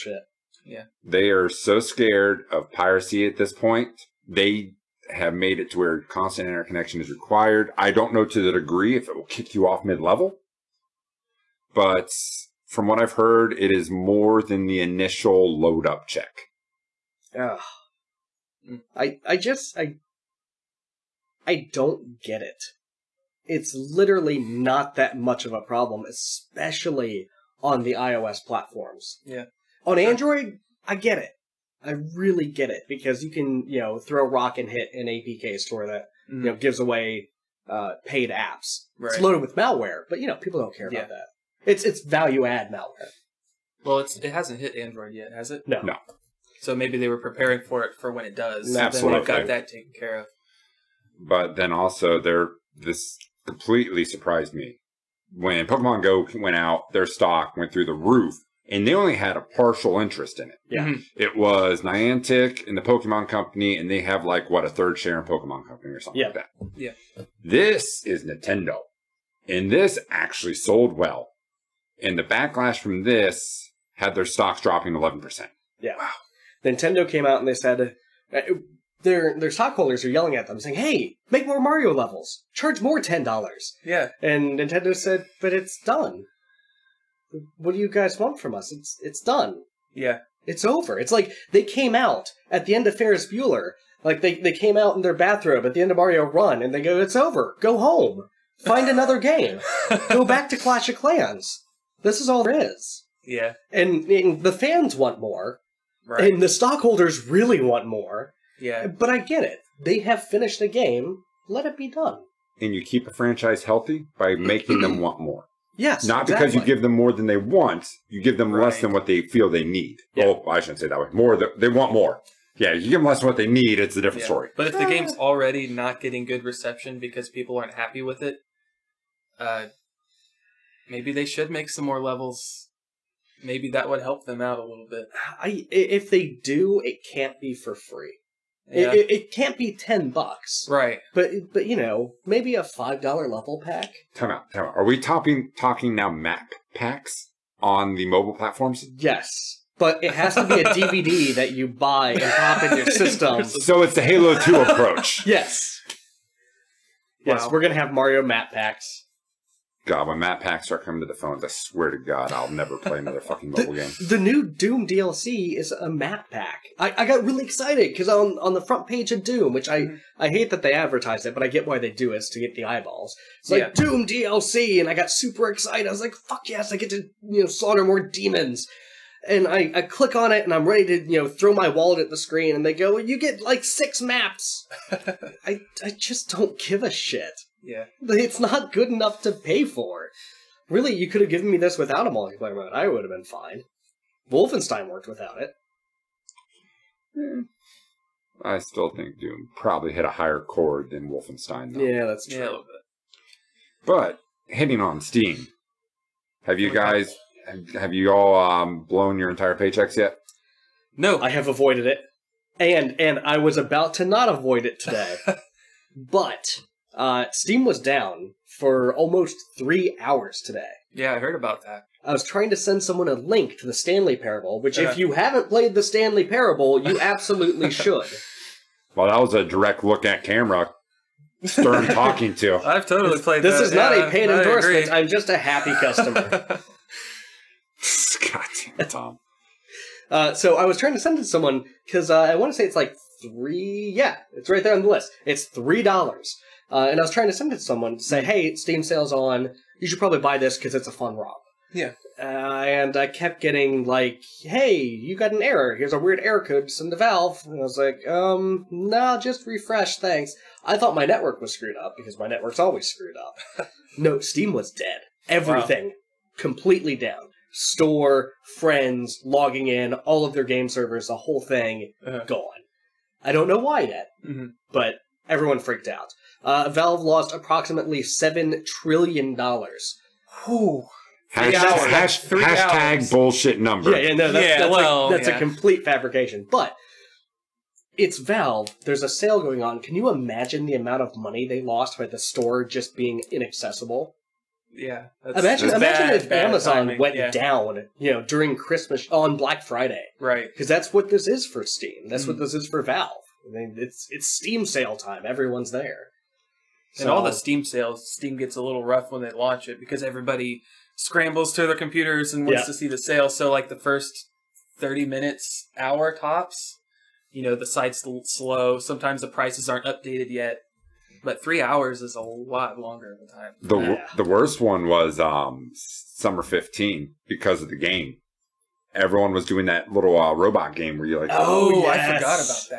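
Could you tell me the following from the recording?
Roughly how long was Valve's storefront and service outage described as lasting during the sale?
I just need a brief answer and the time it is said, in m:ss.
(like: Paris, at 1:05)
almost 3 hours, at 3:38.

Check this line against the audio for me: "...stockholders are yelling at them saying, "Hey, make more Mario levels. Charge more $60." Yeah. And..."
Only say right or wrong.
wrong.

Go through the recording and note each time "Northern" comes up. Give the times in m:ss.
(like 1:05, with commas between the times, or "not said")
not said.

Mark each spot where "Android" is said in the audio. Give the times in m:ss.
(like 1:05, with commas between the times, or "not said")
0:29, 0:44.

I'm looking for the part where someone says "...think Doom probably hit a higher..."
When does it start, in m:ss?
3:18.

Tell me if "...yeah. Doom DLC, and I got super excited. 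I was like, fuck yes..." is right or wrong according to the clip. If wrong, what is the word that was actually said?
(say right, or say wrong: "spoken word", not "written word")
right.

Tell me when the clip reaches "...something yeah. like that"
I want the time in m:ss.
1:05.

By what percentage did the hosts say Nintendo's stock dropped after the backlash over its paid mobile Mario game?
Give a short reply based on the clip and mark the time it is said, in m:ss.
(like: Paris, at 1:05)
11%, at 1:14.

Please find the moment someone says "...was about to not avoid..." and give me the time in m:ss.
3:33.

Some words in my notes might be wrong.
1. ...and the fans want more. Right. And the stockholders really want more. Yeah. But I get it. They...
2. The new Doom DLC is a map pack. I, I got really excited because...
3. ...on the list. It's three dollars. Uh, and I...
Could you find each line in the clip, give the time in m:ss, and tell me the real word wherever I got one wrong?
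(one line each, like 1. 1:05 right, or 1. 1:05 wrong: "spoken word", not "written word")
1. 1:44 right
2. 2:44 right
3. 4:04 right.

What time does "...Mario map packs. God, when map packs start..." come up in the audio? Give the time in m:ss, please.
2:37.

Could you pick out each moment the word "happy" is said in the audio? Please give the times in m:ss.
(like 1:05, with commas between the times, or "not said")
2:07, 3:55.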